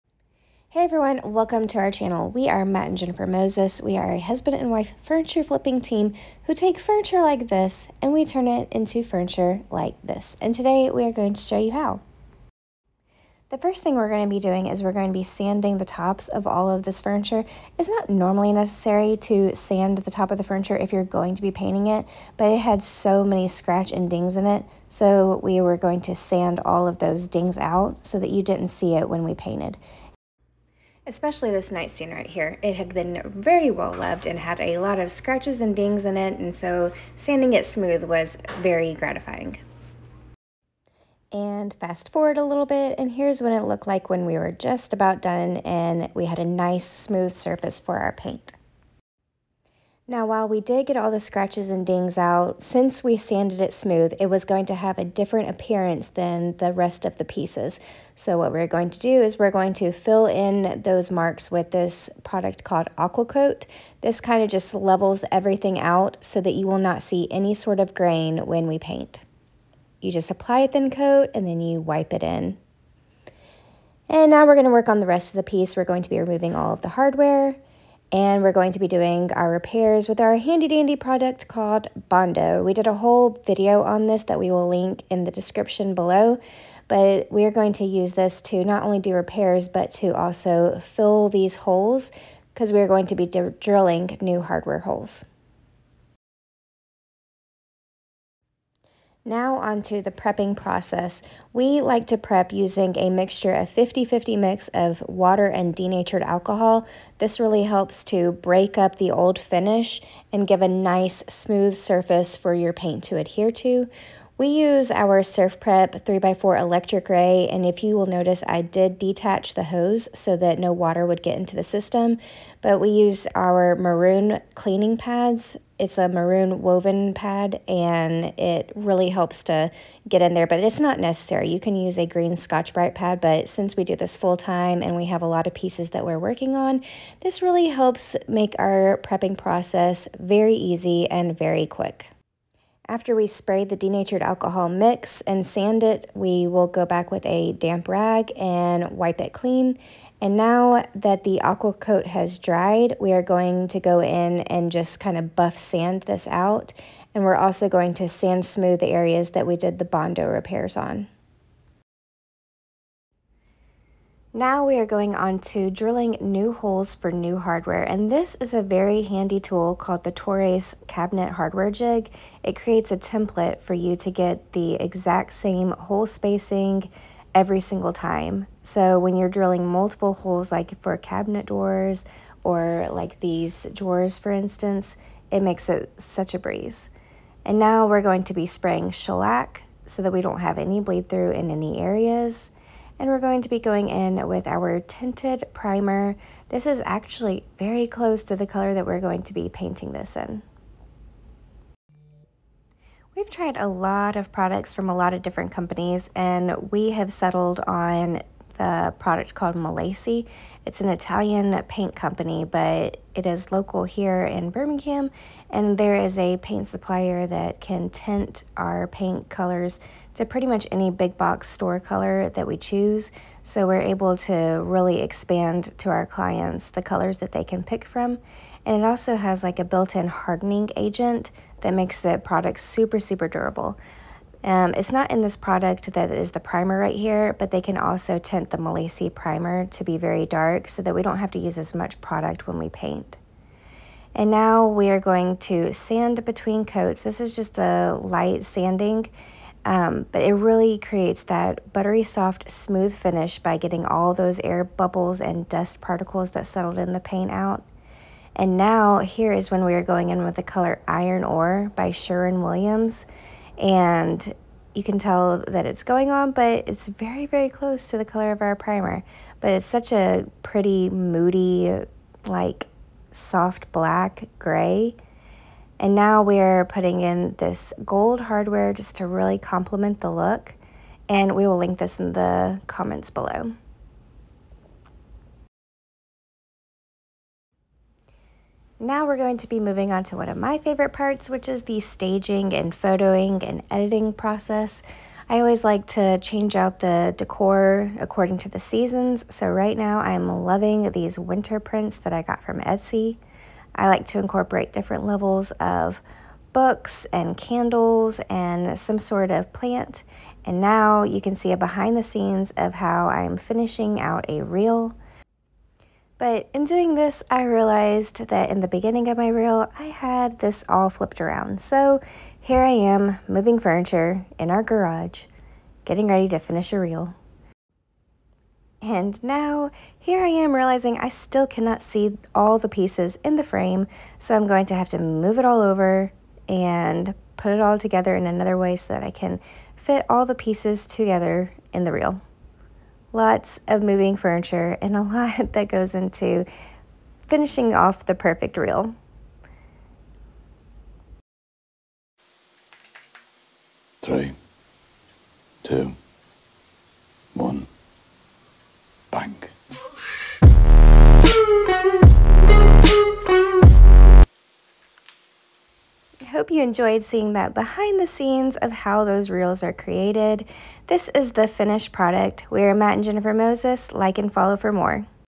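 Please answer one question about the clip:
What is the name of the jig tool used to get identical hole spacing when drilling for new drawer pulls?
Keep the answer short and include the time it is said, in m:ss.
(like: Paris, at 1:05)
Tourace cabinet hardware jig, at 2:50.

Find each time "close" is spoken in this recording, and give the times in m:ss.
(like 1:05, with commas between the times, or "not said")
3:17, 4:27.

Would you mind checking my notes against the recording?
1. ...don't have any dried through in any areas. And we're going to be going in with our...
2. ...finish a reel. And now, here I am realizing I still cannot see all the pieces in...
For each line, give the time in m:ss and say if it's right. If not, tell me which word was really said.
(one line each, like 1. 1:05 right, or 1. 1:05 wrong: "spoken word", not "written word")
1. 3:10 wrong: "bleed", not "dried"
2. 5:26 right.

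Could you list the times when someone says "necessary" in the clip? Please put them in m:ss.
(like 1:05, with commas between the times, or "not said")
0:18, 2:10.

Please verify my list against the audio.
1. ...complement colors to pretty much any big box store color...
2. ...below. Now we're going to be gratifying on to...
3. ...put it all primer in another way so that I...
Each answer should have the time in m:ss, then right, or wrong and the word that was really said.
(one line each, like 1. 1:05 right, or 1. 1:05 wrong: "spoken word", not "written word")
1. 3:38 wrong: "paint", not "complement"
2. 4:43 wrong: "moving", not "gratifying"
3. 5:37 wrong: "together", not "primer".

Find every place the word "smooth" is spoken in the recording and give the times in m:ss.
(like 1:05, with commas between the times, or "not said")
0:37, 0:46, 0:53, 1:51, 2:38, 4:12.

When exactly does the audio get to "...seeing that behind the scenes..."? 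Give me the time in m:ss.
6:07.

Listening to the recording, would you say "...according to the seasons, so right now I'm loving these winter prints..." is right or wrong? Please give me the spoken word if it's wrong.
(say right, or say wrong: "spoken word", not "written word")
right.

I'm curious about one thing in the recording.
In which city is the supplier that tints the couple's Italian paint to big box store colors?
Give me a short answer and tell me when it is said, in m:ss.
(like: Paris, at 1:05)
Birmingham, at 3:34.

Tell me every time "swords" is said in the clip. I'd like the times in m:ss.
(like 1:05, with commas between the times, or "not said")
not said.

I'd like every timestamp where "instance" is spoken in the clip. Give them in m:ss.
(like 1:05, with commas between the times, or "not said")
3:04.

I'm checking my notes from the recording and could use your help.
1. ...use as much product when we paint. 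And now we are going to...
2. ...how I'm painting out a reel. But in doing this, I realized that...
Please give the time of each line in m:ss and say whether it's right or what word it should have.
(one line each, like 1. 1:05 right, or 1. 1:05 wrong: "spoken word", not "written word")
1. 4:01 right
2. 5:12 wrong: "finishing", not "painting".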